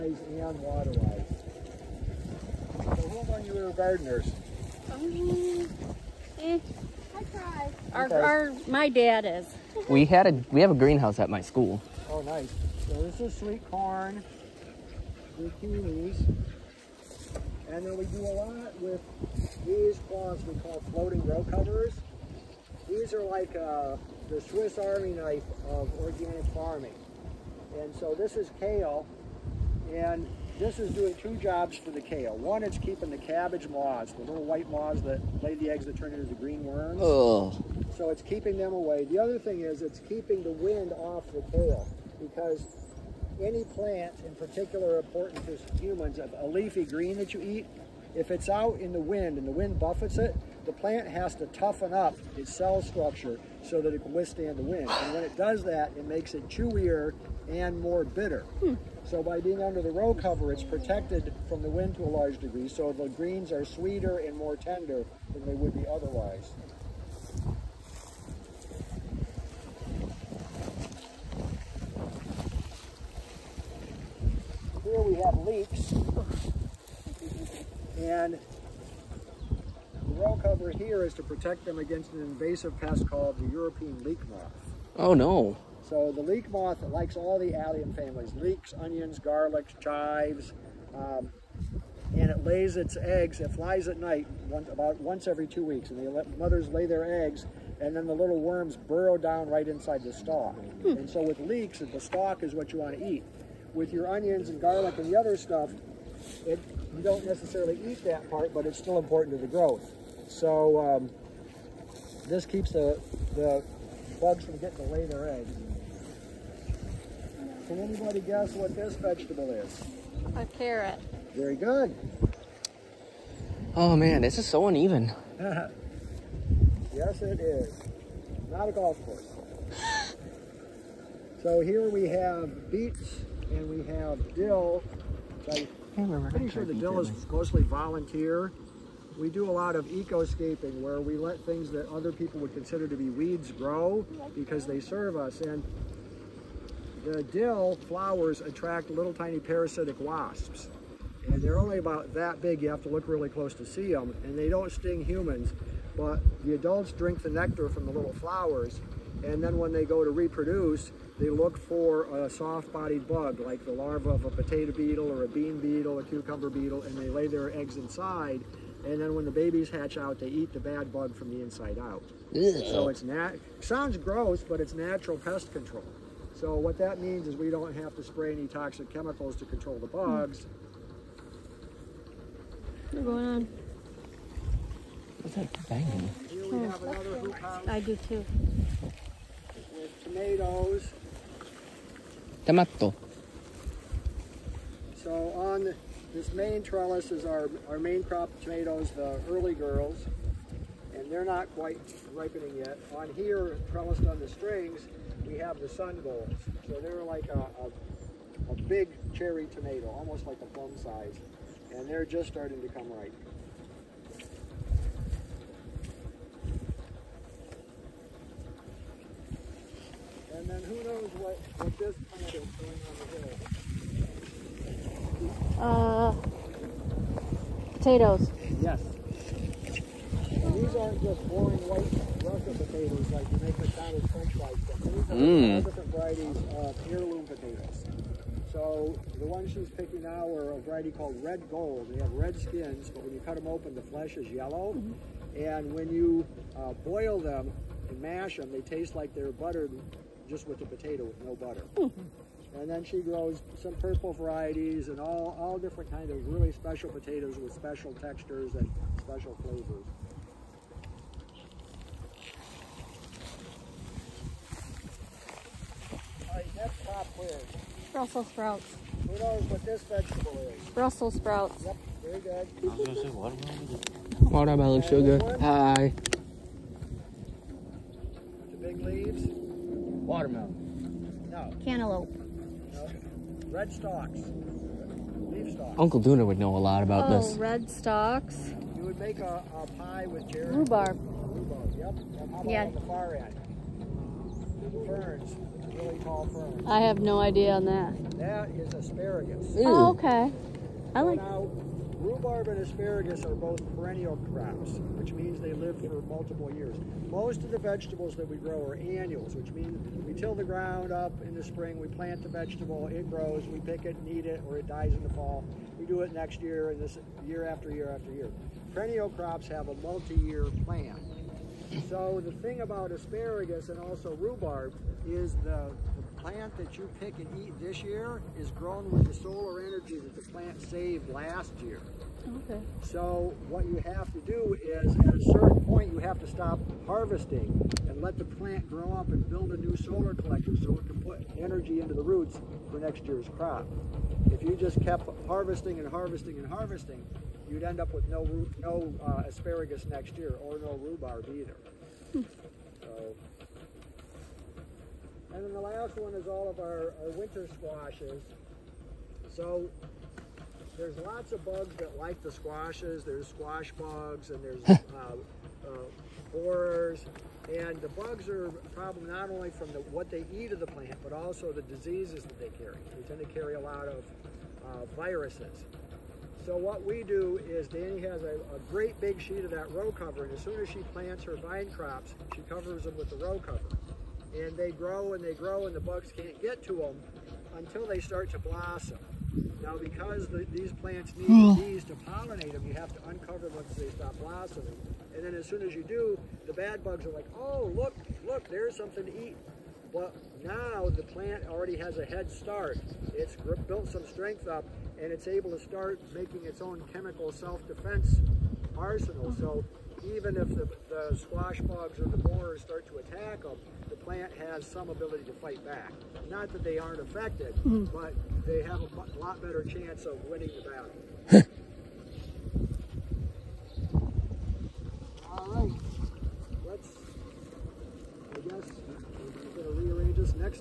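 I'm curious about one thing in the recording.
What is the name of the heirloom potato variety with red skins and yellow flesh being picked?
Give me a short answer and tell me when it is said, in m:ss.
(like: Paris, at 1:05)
Red Gold, at 4:01.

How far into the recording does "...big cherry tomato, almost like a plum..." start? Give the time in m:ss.
3:28.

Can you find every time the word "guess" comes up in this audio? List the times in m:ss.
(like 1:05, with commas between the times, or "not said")
1:58, 7:08.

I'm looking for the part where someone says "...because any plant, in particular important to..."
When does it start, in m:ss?
0:42.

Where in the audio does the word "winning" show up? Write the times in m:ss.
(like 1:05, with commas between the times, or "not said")
7:00.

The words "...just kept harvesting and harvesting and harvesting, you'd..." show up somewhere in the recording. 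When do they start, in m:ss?
5:44.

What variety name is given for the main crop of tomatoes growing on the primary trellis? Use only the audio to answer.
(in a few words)
Early Girls.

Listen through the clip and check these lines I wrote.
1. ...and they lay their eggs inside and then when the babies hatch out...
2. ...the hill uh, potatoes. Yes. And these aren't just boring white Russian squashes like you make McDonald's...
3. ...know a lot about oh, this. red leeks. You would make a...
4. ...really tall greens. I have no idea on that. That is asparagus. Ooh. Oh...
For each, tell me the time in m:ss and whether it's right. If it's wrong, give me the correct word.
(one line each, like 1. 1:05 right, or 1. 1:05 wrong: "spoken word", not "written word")
1. 2:46 right
2. 3:43 wrong: "potatoes", not "squashes"
3. 4:46 wrong: "stalks", not "leeks"
4. 4:55 wrong: "ferns", not "greens".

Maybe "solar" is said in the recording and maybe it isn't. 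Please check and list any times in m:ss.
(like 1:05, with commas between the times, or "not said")
5:29, 5:39.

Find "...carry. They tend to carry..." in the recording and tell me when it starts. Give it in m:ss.
6:12.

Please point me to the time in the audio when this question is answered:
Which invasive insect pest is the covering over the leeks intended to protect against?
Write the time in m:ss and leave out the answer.
1:23.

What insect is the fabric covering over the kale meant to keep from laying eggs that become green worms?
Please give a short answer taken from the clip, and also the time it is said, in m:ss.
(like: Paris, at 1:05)
cabbage moths, at 0:33.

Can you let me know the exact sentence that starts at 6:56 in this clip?
Not that they aren't affected, mm.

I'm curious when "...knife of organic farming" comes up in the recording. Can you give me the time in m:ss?
0:25.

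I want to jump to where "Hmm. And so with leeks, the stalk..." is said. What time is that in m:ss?
1:40.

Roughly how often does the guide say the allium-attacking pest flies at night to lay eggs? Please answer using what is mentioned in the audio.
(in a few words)
once every two weeks.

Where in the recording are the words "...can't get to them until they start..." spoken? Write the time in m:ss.
6:26.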